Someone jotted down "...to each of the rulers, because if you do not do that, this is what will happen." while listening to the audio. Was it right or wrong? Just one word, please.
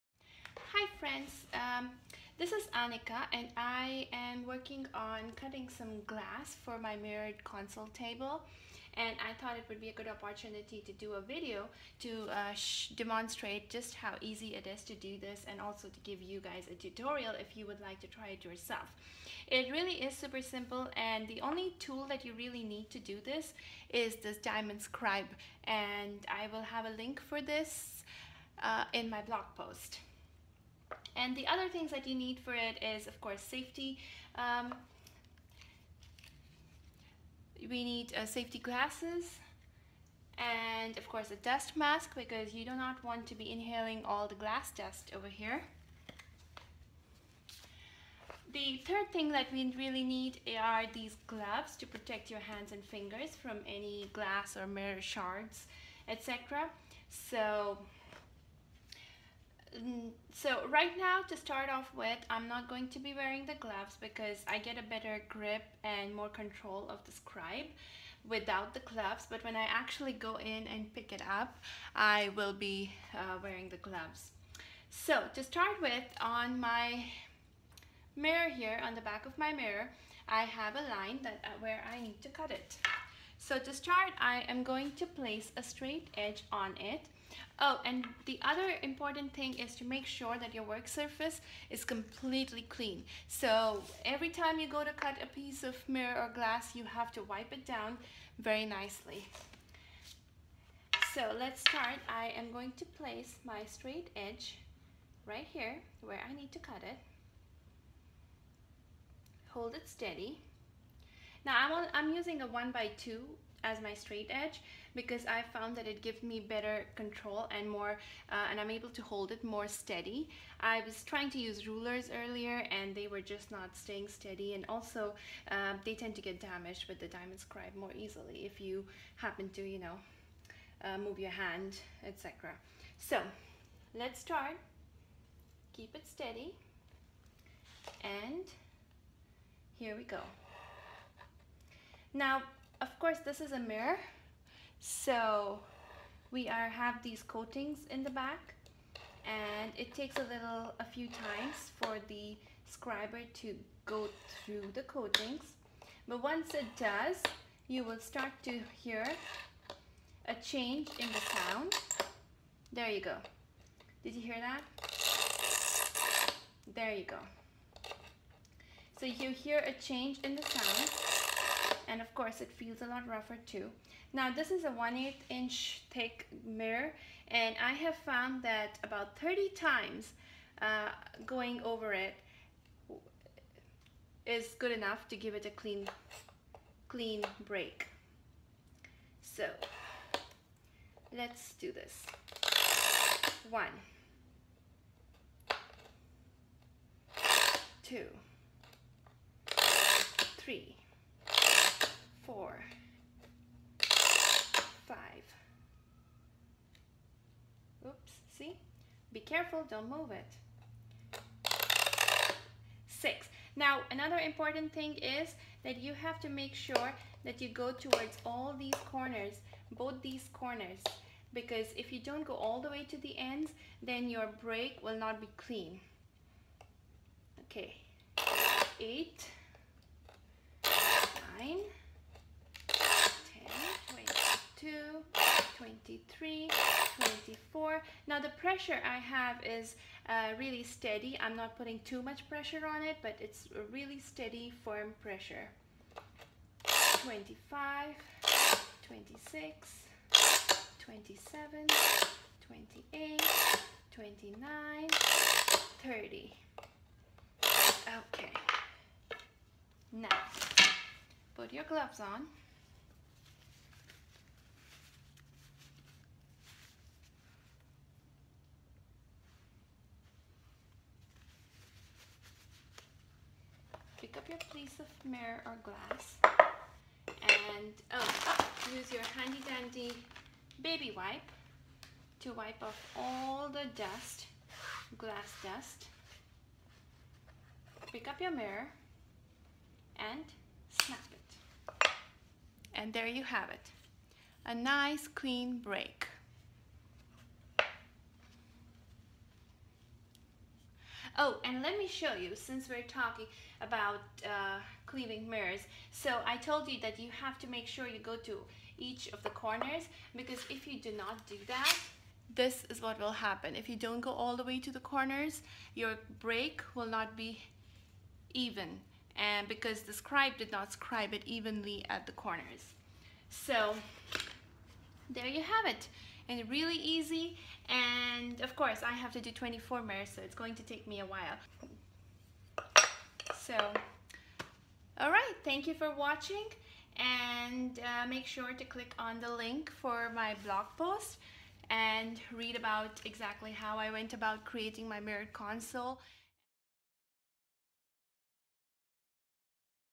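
wrong.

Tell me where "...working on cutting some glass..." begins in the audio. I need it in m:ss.
0:04.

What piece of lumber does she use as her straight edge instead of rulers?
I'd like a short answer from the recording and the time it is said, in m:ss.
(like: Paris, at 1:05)
1 by 2, at 1:52.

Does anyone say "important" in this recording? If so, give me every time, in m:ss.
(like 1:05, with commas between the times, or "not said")
1:28, 3:34.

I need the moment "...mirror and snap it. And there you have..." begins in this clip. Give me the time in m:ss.
4:48.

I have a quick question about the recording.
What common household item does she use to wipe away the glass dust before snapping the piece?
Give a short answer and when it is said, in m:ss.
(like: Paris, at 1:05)
baby wipe, at 4:40.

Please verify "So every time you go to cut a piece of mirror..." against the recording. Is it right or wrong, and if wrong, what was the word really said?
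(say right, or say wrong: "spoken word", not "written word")
right.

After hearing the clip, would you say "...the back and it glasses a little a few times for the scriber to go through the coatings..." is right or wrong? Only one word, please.
wrong.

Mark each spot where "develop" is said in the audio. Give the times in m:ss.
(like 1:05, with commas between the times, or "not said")
not said.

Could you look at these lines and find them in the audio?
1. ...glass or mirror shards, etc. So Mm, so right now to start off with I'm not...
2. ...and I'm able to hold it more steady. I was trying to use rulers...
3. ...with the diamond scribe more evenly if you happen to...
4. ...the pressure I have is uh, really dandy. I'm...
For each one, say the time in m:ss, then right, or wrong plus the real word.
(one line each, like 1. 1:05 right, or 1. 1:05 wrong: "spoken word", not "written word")
1. 0:54 right
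2. 1:58 right
3. 2:06 wrong: "easily", not "evenly"
4. 3:58 wrong: "steady", not "dandy".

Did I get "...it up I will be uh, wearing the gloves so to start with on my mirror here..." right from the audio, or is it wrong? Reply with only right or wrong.
right.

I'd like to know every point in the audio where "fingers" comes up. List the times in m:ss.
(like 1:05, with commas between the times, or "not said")
0:52.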